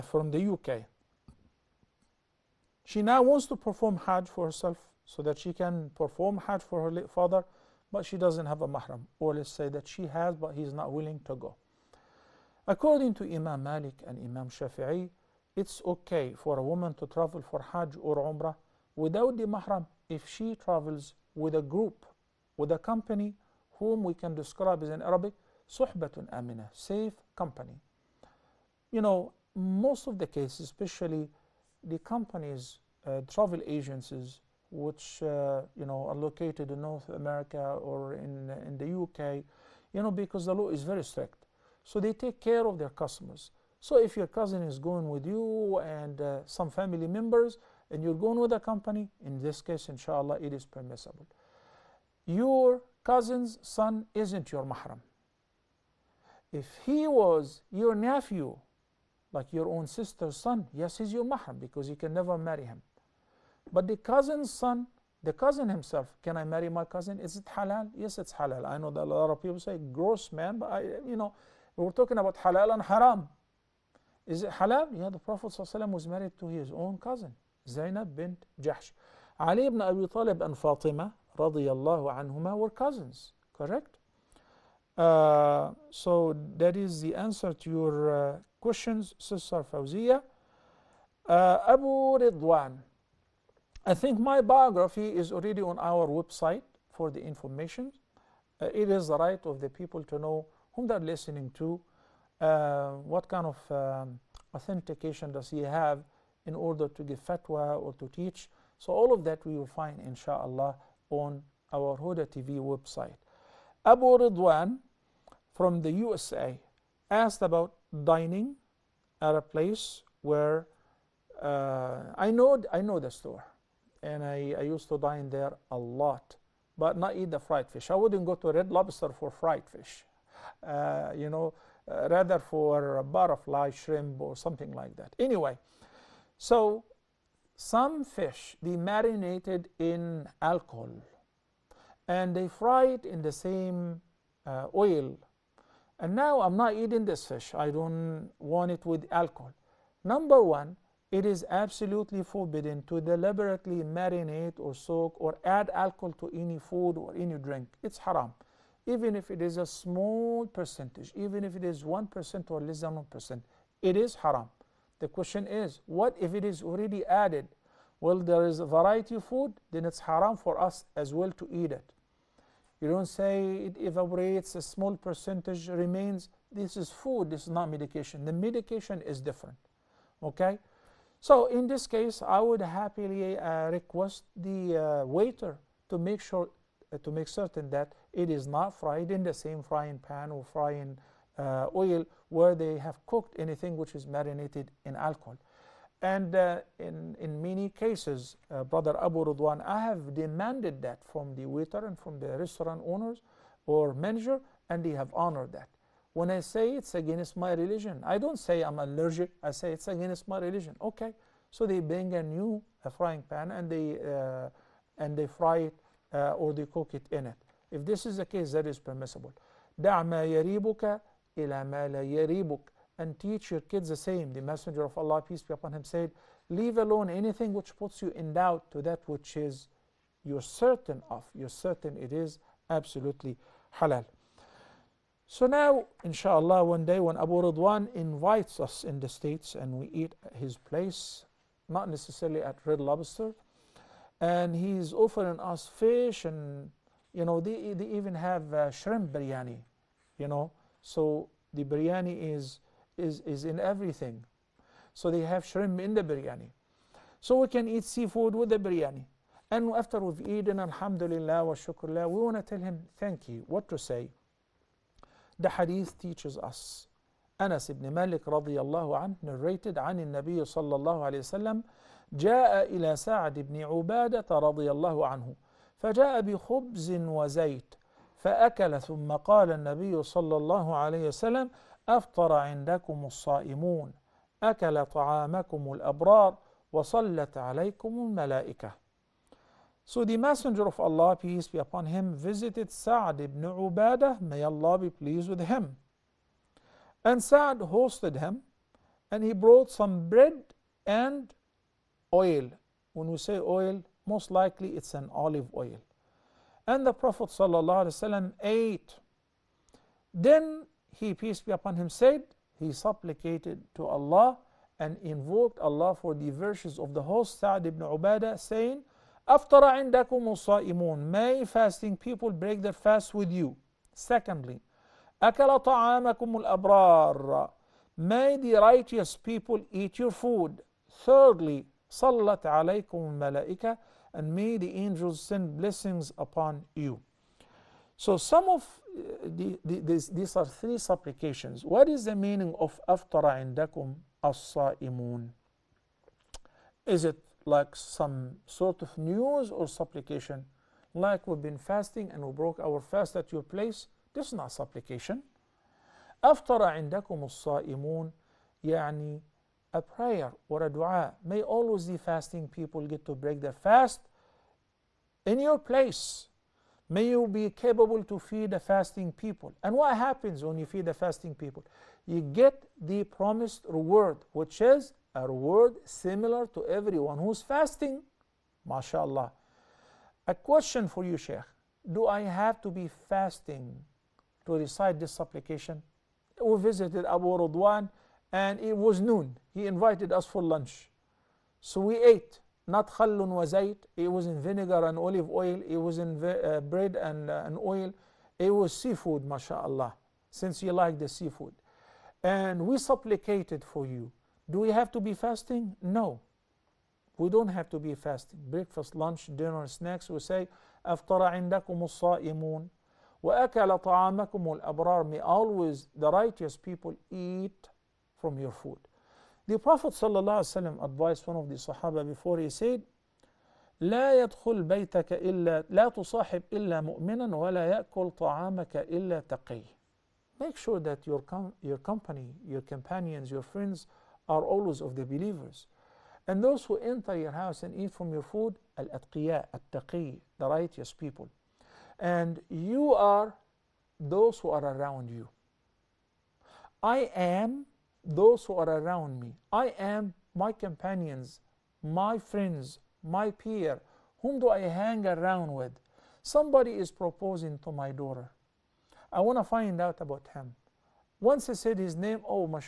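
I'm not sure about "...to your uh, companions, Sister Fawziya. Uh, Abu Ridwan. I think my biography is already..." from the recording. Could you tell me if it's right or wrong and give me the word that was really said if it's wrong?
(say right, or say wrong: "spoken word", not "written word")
wrong: "questions", not "companions".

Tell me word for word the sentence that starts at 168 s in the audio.
Well, there is a variety of food, then it's haram for us as well to eat it.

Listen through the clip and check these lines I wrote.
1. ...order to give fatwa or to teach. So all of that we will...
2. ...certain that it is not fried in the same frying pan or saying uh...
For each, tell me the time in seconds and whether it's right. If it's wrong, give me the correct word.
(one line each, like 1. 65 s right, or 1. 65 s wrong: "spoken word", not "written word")
1. 106 s right
2. 187 s wrong: "frying", not "saying".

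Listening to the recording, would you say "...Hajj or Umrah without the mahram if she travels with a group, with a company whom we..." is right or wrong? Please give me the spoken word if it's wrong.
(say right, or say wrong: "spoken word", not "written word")
right.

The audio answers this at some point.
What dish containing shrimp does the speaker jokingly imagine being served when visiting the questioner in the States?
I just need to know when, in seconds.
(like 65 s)
248 s.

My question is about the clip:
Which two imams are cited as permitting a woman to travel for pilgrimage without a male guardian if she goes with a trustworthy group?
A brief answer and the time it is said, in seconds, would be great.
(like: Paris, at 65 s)
Imam Malik and Imam Shafi'i, at 13 s.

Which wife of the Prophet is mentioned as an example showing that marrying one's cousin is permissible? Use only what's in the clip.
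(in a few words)
Zainab bint Jahsh.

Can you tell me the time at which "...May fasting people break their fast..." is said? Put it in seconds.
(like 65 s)
320 s.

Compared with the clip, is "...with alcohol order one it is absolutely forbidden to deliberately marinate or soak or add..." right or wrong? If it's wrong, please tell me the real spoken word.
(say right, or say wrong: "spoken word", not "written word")
wrong: "number", not "order".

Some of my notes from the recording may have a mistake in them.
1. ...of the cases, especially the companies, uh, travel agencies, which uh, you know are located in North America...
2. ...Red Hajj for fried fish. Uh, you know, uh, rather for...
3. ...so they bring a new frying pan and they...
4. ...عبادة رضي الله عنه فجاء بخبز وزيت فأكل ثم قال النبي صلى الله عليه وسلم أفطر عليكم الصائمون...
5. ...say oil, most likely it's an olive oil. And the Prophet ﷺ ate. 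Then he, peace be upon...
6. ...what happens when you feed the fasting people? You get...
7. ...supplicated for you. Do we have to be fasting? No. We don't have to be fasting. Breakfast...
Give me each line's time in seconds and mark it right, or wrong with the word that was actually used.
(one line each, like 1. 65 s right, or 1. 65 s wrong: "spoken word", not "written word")
1. 30 s right
2. 128 s wrong: "Lobster", not "Hajj"
3. 211 s right
4. 273 s wrong: "عندكم", not "عليكم"
5. 303 s right
6. 369 s right
7. 402 s right.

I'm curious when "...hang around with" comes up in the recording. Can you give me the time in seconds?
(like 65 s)
454 s.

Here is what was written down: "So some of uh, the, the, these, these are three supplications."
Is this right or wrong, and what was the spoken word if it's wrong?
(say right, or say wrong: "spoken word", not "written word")
right.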